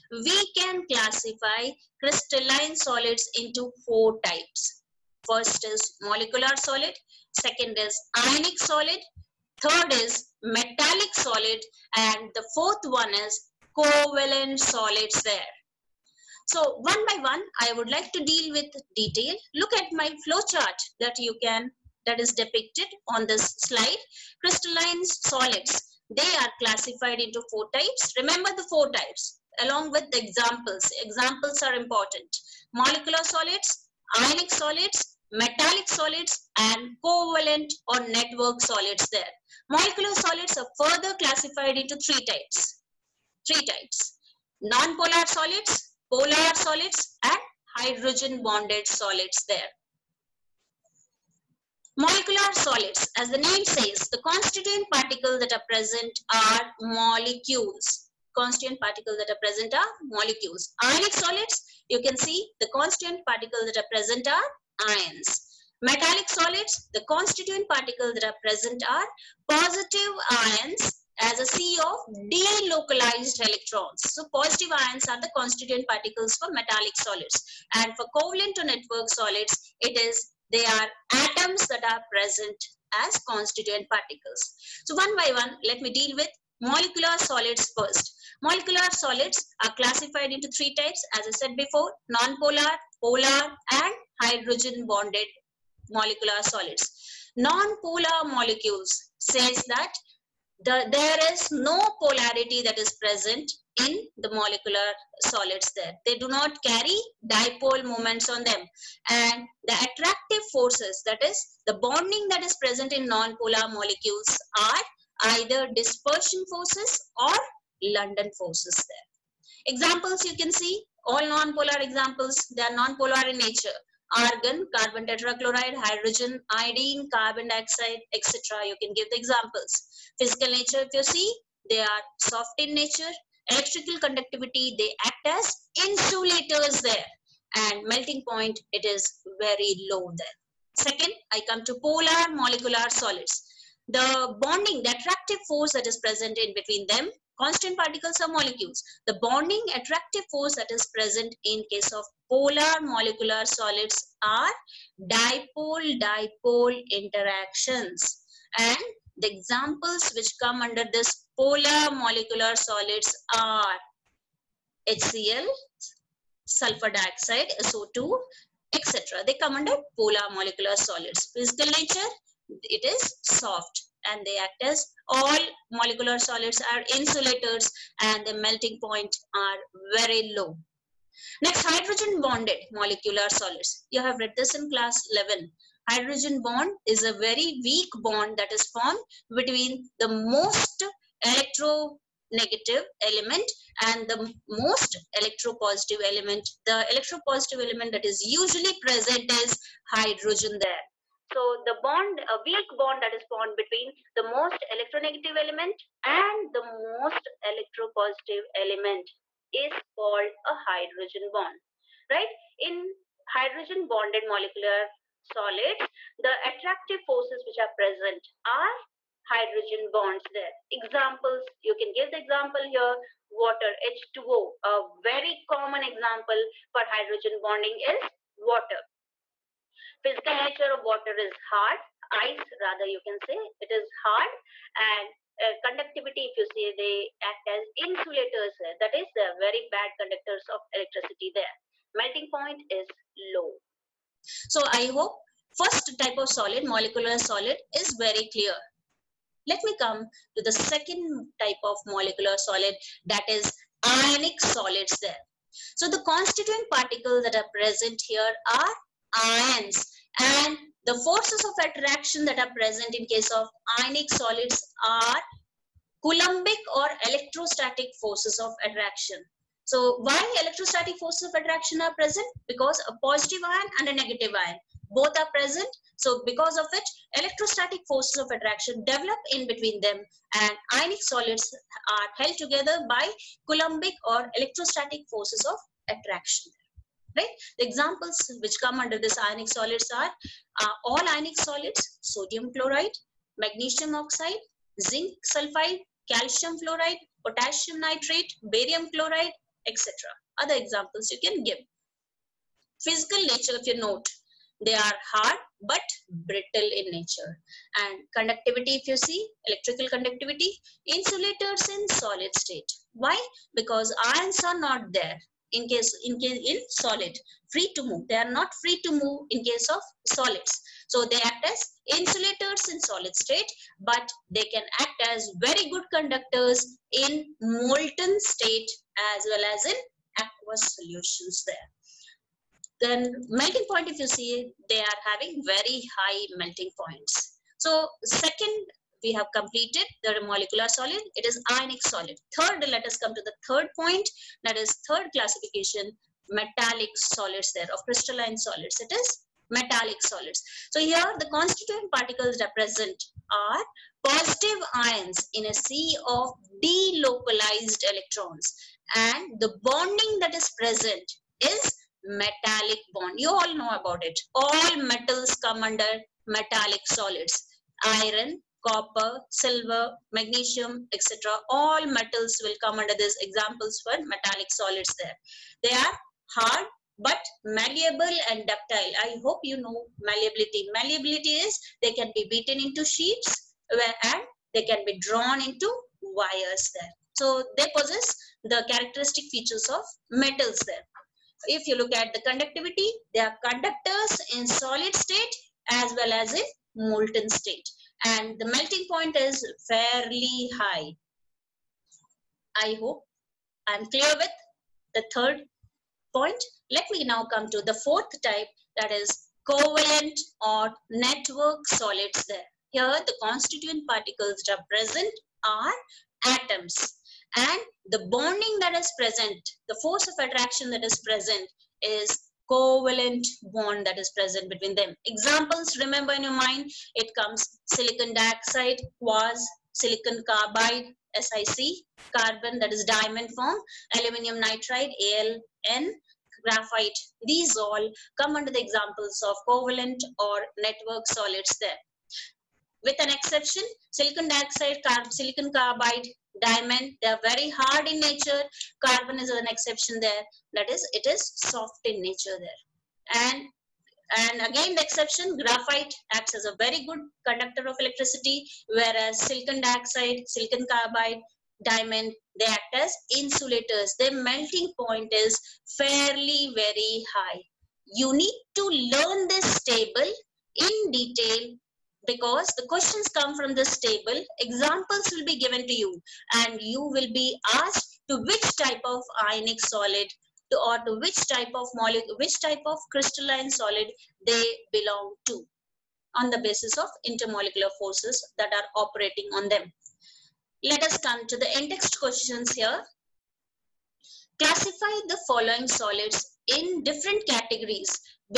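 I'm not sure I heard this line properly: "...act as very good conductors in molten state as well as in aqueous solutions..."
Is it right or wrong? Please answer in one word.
right.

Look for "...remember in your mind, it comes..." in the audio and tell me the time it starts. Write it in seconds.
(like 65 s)
425 s.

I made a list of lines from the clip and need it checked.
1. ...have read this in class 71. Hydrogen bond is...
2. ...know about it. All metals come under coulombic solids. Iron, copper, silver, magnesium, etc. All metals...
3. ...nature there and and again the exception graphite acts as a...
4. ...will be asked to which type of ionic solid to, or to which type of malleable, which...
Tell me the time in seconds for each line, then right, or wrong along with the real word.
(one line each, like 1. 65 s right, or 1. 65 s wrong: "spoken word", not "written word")
1. 184 s wrong: "11", not "71"
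2. 363 s wrong: "metallic", not "coulombic"
3. 452 s right
4. 476 s wrong: "molecule", not "malleable".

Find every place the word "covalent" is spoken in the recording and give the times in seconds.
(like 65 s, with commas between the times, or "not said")
13 s, 37 s, 78 s, 409 s, 422 s, 439 s.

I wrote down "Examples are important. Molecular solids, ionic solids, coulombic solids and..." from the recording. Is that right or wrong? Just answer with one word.
wrong.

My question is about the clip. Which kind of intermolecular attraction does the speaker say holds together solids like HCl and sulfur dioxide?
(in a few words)
Dipole-dipole interactions.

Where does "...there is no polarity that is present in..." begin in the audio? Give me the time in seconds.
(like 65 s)
100 s.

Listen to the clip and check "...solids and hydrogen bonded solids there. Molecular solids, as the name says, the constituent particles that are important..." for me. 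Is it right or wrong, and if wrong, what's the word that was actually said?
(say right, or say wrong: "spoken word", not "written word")
wrong: "present", not "important".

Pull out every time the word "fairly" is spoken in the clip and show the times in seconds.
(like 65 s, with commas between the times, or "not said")
399 s, 465 s.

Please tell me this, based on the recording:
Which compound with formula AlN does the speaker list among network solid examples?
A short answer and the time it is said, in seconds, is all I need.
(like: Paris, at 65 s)
Aluminium nitride, at 433 s.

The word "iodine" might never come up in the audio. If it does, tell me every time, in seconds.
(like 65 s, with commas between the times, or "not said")
126 s.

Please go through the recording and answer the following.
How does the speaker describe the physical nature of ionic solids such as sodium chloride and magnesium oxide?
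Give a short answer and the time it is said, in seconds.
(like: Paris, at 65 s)
Hard but brittle, at 305 s.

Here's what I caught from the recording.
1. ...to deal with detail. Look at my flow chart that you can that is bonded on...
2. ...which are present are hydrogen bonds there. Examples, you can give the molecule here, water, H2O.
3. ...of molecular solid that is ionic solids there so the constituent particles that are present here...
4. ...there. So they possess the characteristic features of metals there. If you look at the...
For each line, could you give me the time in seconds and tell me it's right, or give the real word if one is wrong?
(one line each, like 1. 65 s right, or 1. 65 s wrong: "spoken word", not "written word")
1. 18 s wrong: "depicted", not "bonded"
2. 217 s wrong: "example", not "molecule"
3. 251 s right
4. 386 s right.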